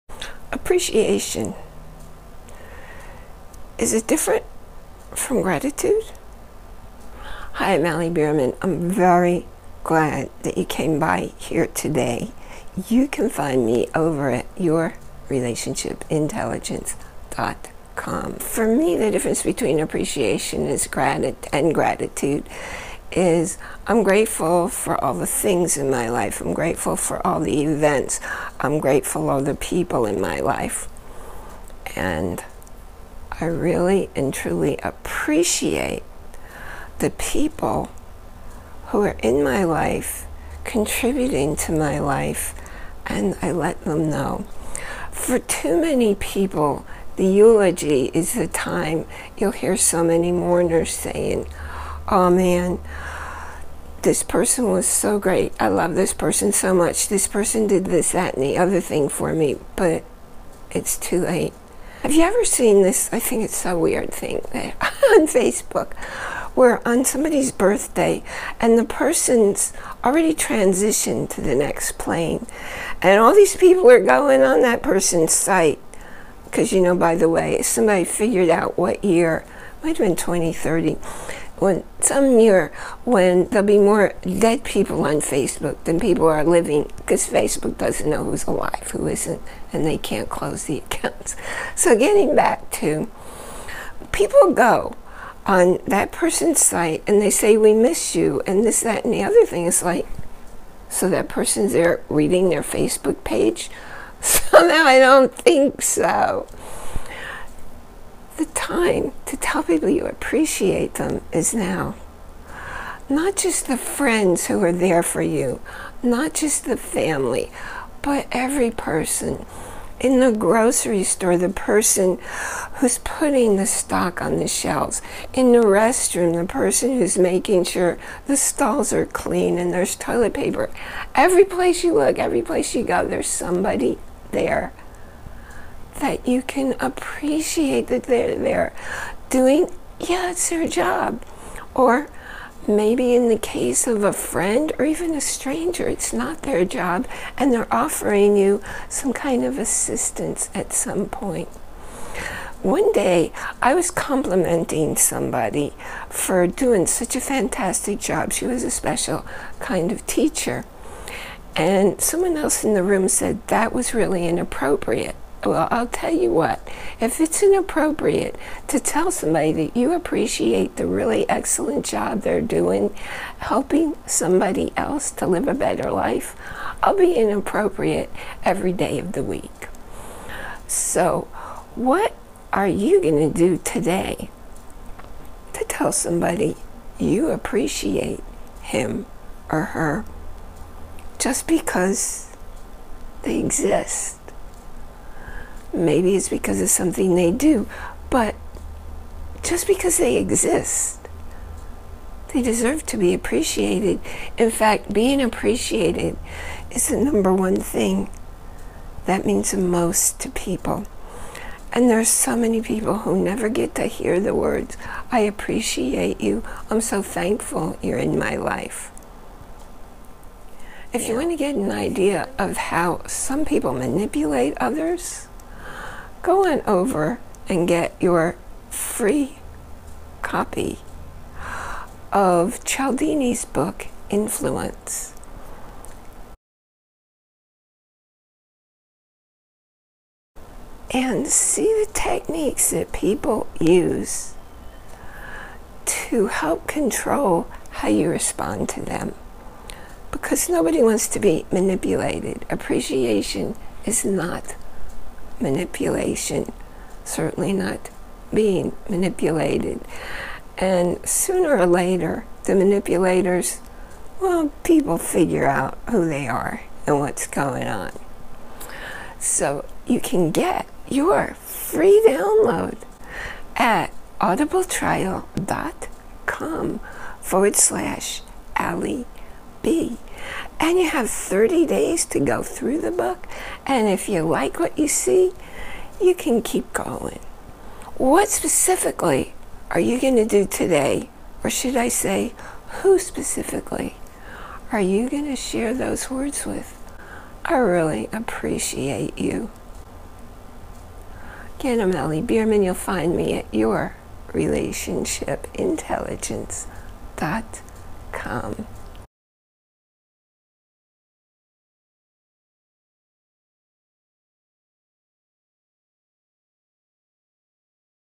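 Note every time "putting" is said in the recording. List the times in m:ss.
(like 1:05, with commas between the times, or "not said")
2:02.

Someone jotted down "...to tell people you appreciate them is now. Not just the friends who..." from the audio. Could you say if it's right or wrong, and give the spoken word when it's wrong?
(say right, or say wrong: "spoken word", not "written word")
right.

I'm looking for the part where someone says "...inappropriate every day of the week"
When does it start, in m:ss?
2:57.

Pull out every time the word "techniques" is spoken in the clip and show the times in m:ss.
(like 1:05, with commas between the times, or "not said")
4:01.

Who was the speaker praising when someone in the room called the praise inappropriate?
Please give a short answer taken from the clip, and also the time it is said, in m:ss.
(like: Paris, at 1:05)
A special kind of teacher, at 2:38.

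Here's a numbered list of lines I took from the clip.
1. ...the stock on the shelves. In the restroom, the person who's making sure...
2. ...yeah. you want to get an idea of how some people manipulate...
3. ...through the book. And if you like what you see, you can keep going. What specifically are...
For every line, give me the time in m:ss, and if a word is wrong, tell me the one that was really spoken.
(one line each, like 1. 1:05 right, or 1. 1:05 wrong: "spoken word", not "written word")
1. 2:03 right
2. 3:41 right
3. 4:42 right.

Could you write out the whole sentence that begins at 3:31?
And there's so many people who never get to hear the words, I appreciate you.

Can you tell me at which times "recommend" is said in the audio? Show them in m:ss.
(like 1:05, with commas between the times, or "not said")
not said.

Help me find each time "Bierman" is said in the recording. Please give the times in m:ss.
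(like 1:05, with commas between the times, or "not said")
0:08, 5:02.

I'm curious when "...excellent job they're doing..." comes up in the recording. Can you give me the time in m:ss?
2:51.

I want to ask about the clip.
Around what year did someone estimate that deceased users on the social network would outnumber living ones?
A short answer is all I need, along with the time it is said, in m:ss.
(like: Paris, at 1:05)
2030, at 1:20.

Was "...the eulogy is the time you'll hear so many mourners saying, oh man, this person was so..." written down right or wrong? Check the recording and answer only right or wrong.
right.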